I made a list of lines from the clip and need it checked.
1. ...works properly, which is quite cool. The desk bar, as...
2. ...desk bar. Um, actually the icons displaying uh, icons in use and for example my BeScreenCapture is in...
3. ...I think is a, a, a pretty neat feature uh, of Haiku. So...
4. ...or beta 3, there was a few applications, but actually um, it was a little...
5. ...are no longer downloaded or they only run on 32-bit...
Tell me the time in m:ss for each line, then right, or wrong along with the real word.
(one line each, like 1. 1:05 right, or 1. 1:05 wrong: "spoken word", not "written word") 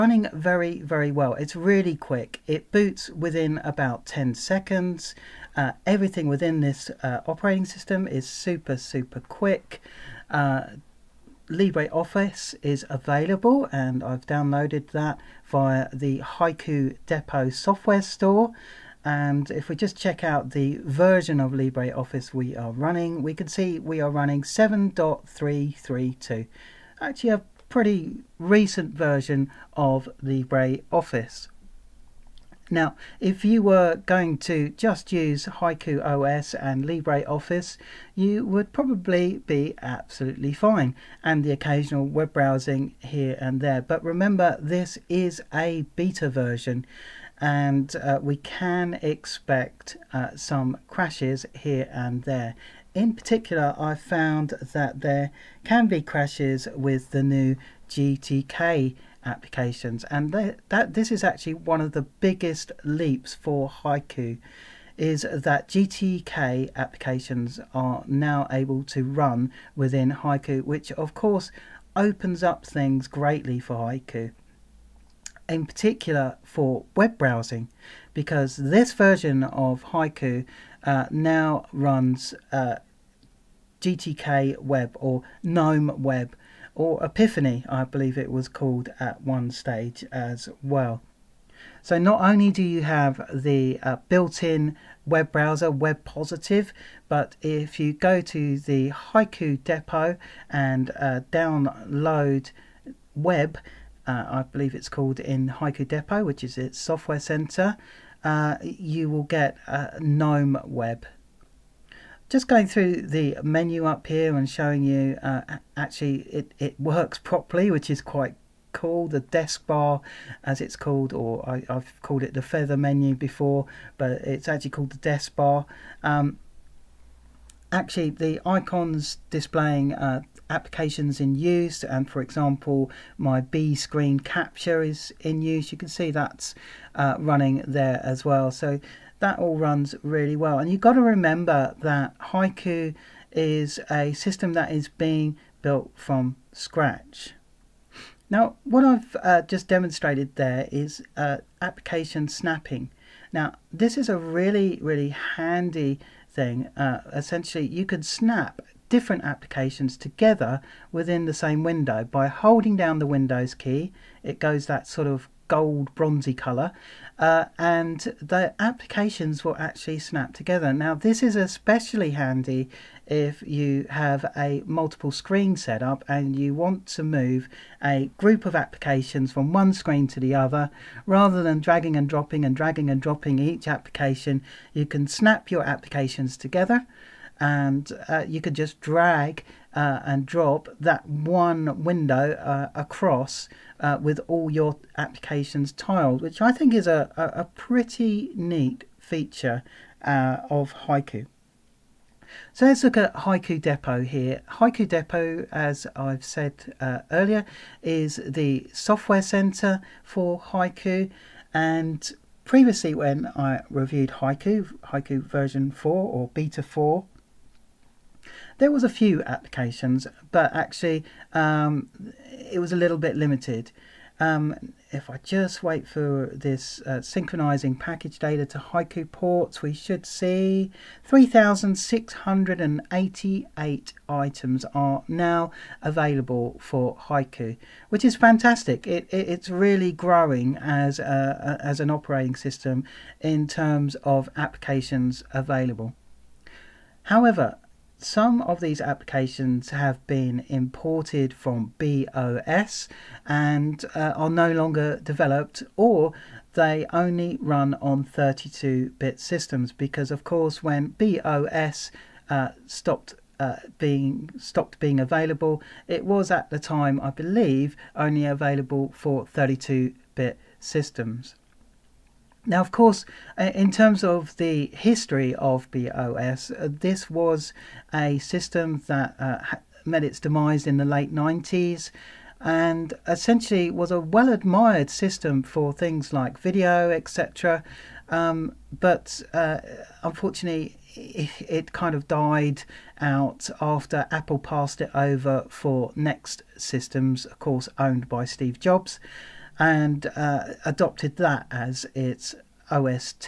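1. 1:56 right
2. 2:04 wrong: "applications", not "icons"
3. 3:16 right
4. 3:35 wrong: "4", not "3"
5. 4:14 wrong: "developed", not "downloaded".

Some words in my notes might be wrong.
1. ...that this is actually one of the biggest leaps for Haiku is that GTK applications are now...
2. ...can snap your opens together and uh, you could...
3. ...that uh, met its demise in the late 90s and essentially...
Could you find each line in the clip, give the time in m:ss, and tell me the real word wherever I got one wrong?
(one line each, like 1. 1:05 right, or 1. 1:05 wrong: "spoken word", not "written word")
1. 1:00 right
2. 3:04 wrong: "applications", not "opens"
3. 4:38 right.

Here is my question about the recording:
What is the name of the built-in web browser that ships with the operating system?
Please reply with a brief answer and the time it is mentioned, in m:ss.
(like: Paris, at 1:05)
Web Positive, at 1:35.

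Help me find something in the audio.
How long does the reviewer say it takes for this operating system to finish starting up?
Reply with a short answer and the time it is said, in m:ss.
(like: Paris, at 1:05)
10 seconds, at 0:04.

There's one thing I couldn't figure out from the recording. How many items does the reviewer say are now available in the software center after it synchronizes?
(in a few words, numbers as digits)
3,688.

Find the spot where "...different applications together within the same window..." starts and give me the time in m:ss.
2:38.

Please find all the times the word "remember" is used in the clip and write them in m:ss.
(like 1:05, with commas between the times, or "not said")
0:44, 2:21.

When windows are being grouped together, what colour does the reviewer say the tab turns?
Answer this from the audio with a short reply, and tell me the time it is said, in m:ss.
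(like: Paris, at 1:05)
gold bronzy, at 2:45.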